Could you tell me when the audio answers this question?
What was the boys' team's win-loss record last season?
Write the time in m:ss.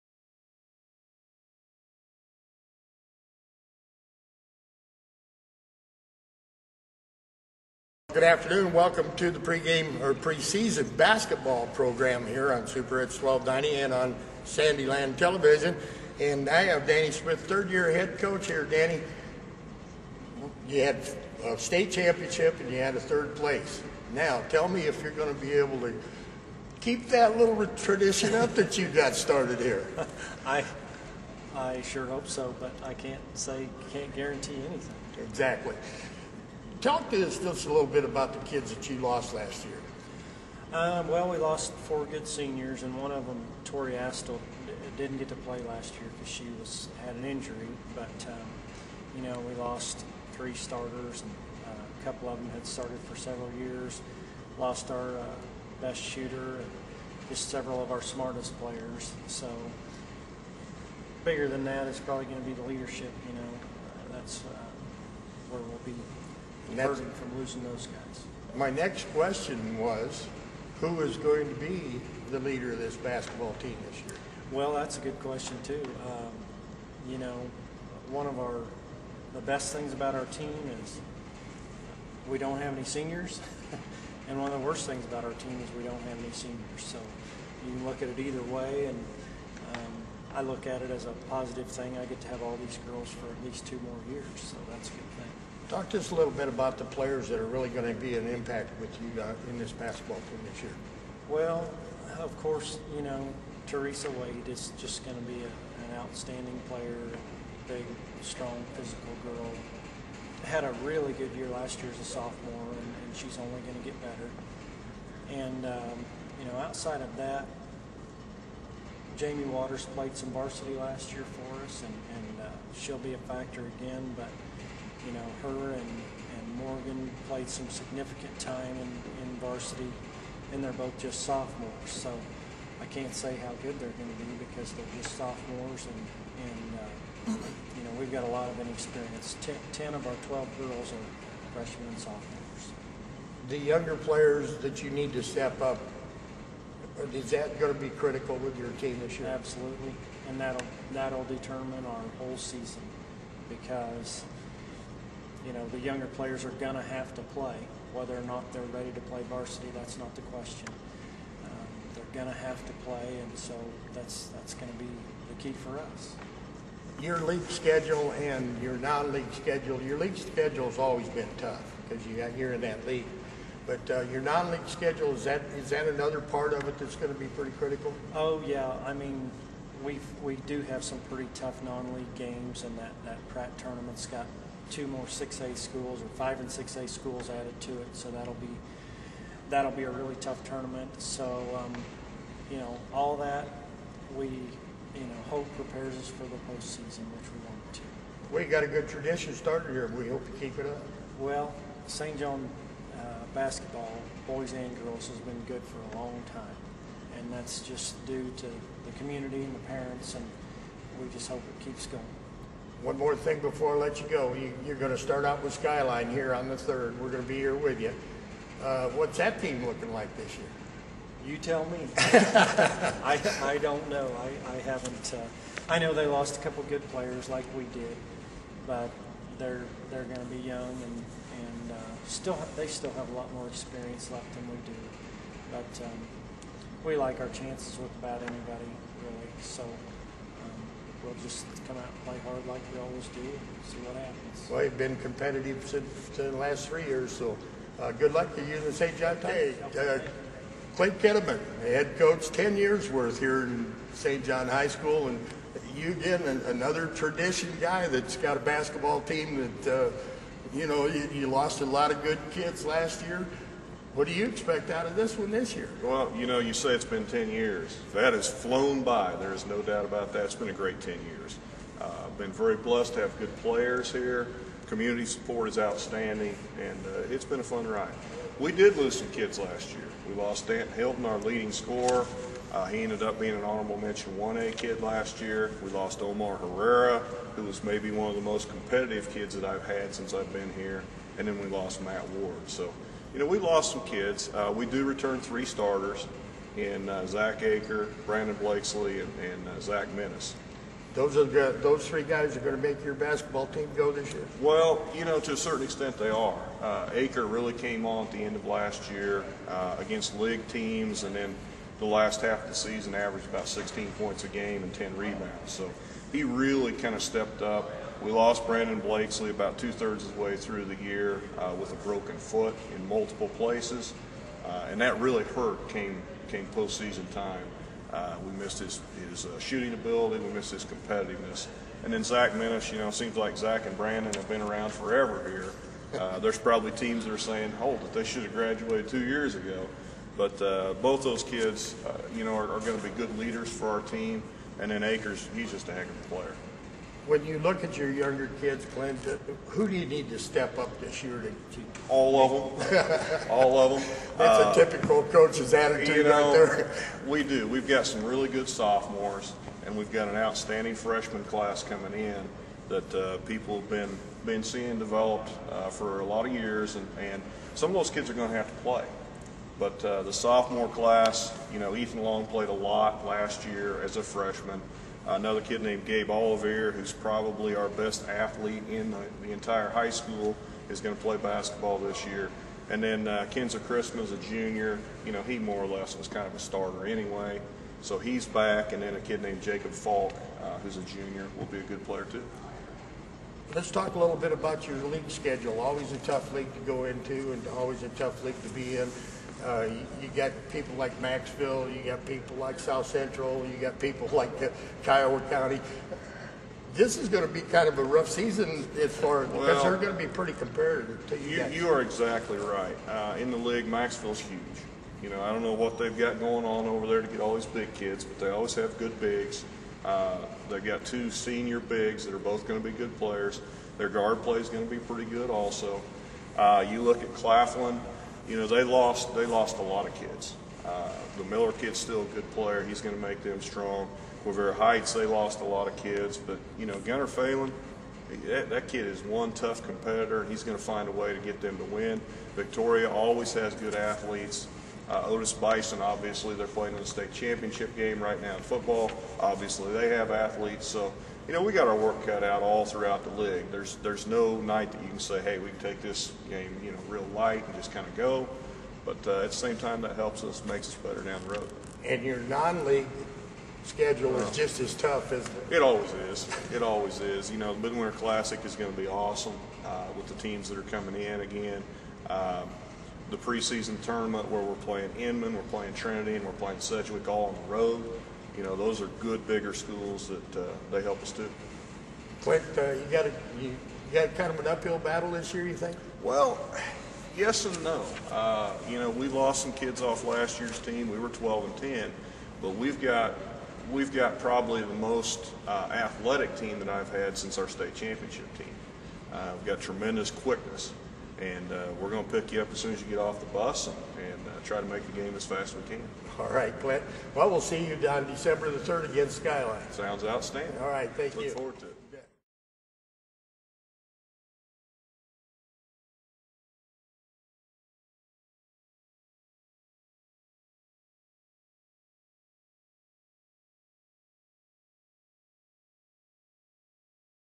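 8:11.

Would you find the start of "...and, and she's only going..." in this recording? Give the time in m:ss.
1:52.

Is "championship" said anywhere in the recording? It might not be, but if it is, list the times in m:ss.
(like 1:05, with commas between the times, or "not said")
0:21, 7:27, 8:17.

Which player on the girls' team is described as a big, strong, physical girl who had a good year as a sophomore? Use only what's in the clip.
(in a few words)
Teresa Wade.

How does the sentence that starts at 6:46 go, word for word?
This is going to be kind of a rough season as far as well, they're going to be pretty competitive.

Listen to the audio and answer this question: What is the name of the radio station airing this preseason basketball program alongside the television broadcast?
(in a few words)
Super Hits 1290.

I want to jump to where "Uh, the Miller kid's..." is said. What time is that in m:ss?
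7:10.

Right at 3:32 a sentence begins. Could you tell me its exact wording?
One more thing before I let you go.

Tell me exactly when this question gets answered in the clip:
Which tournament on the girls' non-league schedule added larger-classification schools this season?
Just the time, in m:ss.
3:03.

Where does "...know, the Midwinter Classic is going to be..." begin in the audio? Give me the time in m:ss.
7:47.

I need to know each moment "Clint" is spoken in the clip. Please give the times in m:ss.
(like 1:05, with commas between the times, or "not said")
5:48, 8:02, 8:26.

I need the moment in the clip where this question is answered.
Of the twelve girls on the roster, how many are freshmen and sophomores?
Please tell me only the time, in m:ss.
2:19.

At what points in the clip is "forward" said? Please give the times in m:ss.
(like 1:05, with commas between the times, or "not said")
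8:31.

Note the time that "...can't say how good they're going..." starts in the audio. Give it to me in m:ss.
2:12.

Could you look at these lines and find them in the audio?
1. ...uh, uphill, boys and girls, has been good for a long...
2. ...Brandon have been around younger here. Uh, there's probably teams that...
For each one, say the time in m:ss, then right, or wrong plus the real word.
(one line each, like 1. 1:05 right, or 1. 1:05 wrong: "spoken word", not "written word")
1. 3:22 wrong: "basketball", not "uphill"
2. 5:33 wrong: "forever", not "younger".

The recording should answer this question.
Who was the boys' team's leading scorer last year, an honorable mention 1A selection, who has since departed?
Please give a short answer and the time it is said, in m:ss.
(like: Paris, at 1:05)
Stanton Hilton, at 4:40.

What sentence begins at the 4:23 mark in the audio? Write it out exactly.
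What do you expect out of this one this year?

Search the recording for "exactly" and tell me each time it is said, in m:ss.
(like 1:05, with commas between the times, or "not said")
0:35, 6:51.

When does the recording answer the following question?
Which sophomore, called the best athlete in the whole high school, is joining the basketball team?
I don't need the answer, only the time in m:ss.
6:15.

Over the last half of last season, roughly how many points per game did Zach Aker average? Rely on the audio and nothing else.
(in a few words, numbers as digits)
16.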